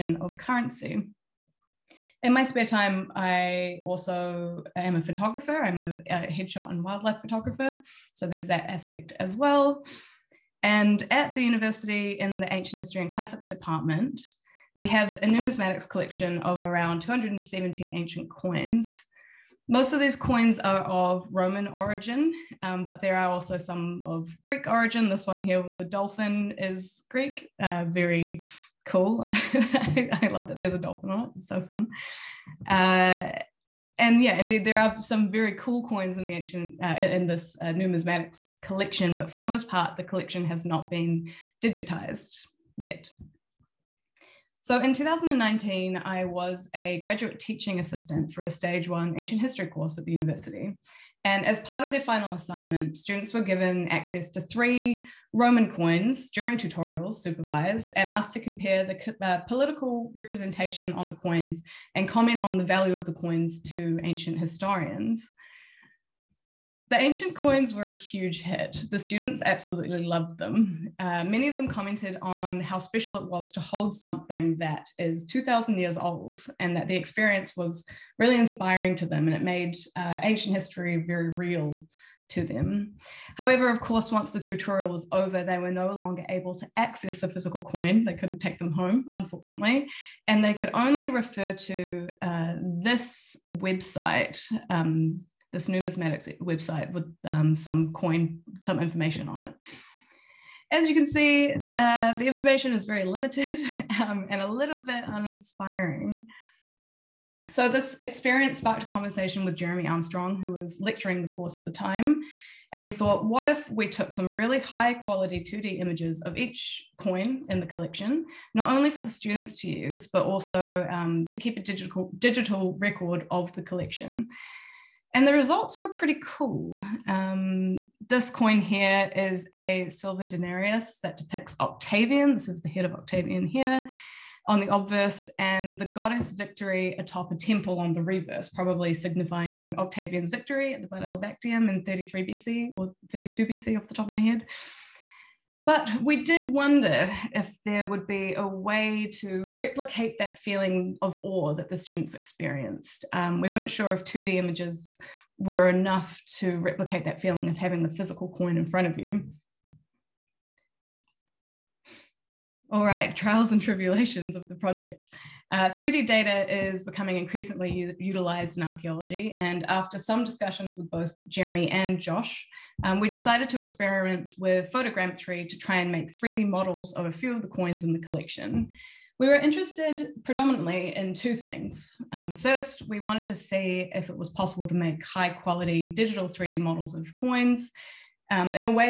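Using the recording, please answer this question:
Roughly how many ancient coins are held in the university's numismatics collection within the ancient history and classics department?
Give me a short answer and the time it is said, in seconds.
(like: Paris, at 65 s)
270, at 16 s.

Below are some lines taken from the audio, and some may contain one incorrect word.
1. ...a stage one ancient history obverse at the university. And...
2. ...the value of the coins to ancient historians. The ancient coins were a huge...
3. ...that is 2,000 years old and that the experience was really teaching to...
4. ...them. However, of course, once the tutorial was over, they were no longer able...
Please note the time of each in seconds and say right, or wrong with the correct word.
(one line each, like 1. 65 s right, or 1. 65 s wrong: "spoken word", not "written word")
1. 48 s wrong: "course", not "obverse"
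2. 62 s right
3. 74 s wrong: "inspiring", not "teaching"
4. 82 s right.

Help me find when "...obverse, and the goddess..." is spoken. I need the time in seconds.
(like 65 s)
134 s.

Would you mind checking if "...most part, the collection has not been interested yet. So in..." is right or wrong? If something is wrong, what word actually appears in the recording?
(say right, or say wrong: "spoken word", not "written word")
wrong: "digitized", not "interested".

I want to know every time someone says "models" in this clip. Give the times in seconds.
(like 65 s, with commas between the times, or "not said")
176 s, 186 s.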